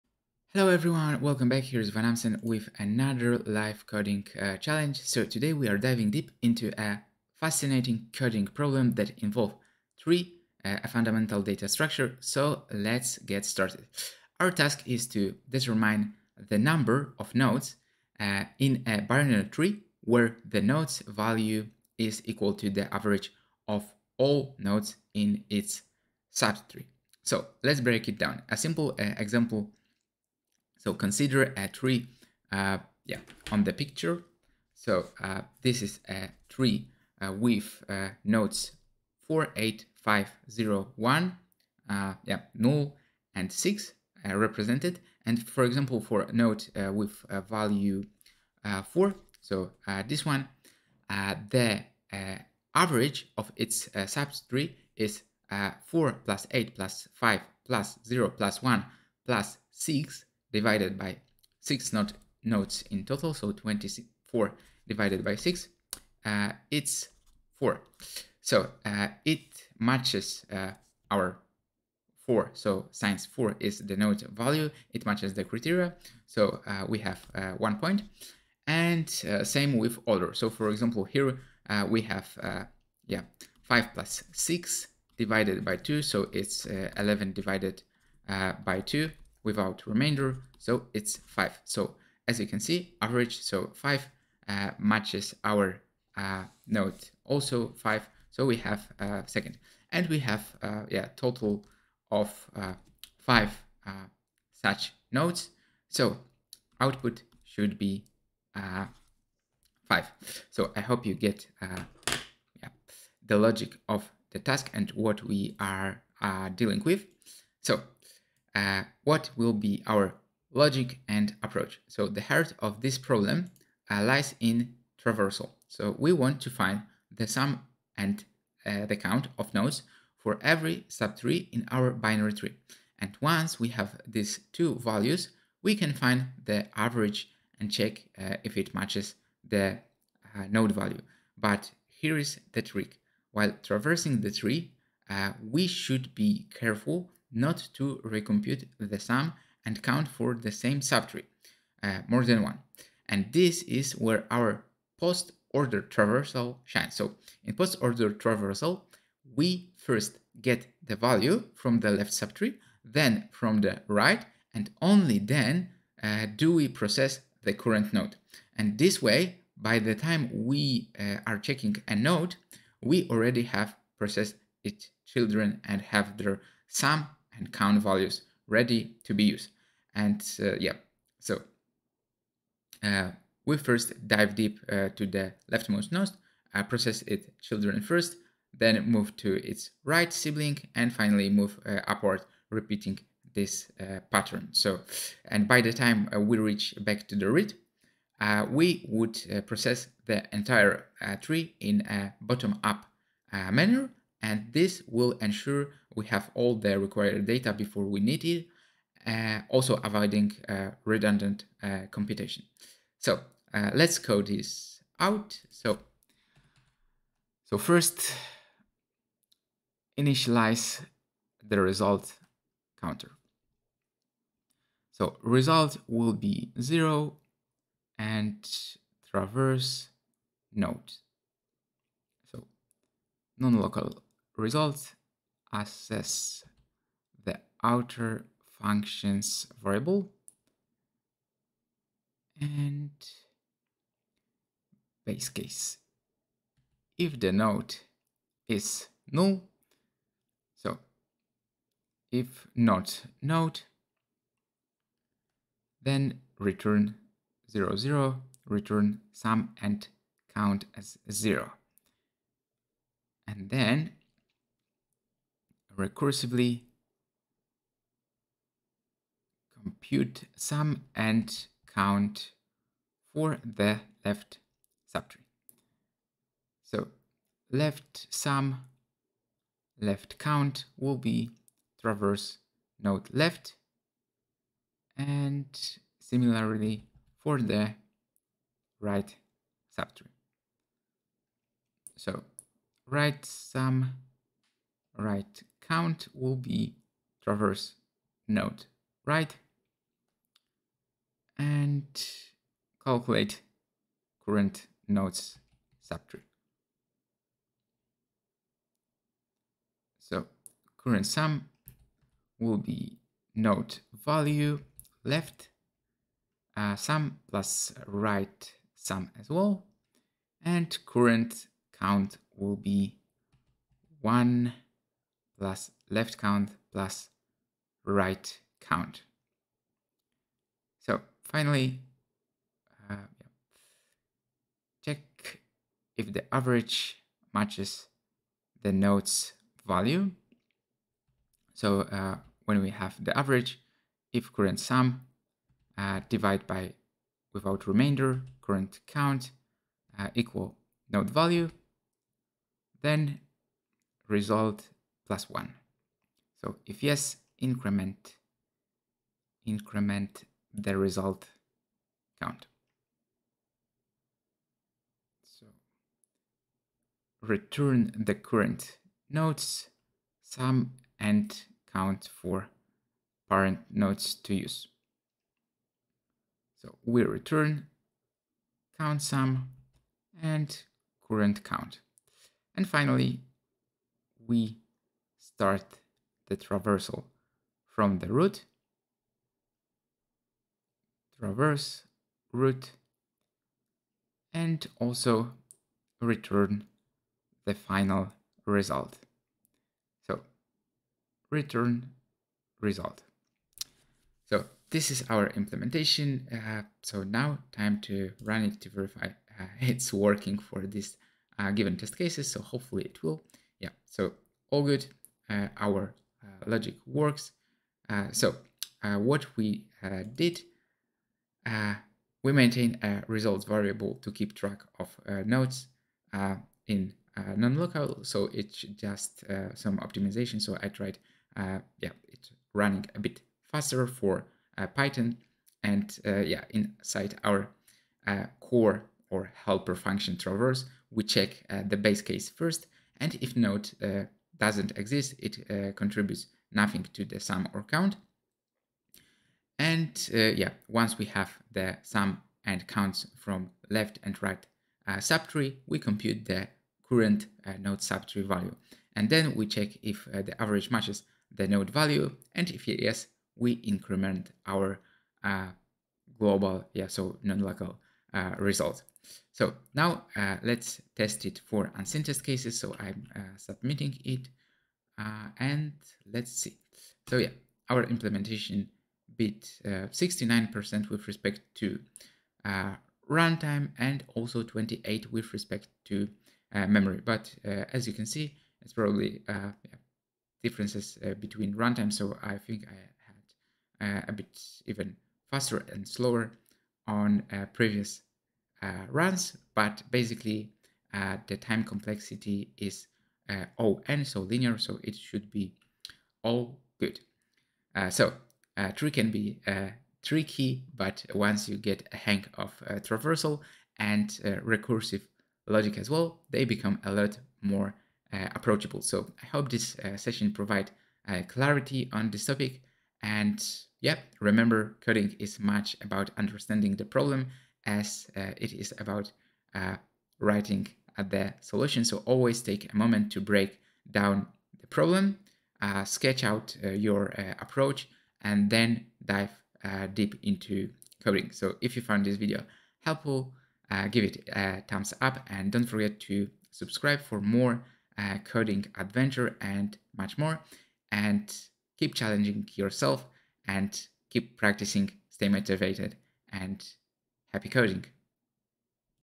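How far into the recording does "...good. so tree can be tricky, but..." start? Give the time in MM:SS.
08:26.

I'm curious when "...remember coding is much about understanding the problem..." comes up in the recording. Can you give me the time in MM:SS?
08:44.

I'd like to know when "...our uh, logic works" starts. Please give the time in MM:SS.
06:55.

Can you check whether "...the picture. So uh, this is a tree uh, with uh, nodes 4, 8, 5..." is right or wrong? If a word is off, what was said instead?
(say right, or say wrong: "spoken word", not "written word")
right.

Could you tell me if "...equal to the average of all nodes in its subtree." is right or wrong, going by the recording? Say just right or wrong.
right.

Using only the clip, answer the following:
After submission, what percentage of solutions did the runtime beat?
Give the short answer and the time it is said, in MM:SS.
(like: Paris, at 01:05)
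69%, at 07:59.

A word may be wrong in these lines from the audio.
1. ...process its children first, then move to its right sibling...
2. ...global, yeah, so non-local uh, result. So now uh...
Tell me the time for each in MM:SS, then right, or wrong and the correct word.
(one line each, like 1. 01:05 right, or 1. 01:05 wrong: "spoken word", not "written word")
1. 03:06 right
2. 07:46 right.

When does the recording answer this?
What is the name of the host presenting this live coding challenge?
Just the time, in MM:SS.
00:01.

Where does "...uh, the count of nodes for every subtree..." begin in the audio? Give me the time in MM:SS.
02:08.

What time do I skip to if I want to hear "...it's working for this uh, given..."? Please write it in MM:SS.
06:49.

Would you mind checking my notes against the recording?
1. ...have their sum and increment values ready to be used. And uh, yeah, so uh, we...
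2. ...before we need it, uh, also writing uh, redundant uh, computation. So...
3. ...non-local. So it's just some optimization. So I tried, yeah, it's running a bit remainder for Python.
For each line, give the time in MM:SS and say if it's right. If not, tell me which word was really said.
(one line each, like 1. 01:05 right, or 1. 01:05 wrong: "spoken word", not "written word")
1. 02:55 wrong: "count", not "increment"
2. 03:27 wrong: "avoiding", not "writing"
3. 07:07 wrong: "faster", not "remainder".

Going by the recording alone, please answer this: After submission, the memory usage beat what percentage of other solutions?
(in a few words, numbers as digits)
28%.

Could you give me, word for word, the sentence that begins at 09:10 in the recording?
And keep challenging yourself and keep practicing, stay motivated and Happy coding!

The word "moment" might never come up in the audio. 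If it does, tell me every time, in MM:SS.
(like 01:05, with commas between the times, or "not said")
08:52.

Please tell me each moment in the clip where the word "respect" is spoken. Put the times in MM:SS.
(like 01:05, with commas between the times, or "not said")
08:01, 08:05.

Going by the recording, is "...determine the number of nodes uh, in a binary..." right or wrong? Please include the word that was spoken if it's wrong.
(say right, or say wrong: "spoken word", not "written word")
right.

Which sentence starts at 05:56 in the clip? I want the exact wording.
So if yes, increment, increment the result count.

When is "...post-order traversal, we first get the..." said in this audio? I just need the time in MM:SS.
02:37.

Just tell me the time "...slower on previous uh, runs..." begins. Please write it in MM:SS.
08:15.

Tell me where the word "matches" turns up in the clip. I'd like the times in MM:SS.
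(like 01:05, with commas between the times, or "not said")
01:09, 01:15, 01:34, 02:18, 05:37, 07:40.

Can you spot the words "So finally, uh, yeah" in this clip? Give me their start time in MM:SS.
05:30.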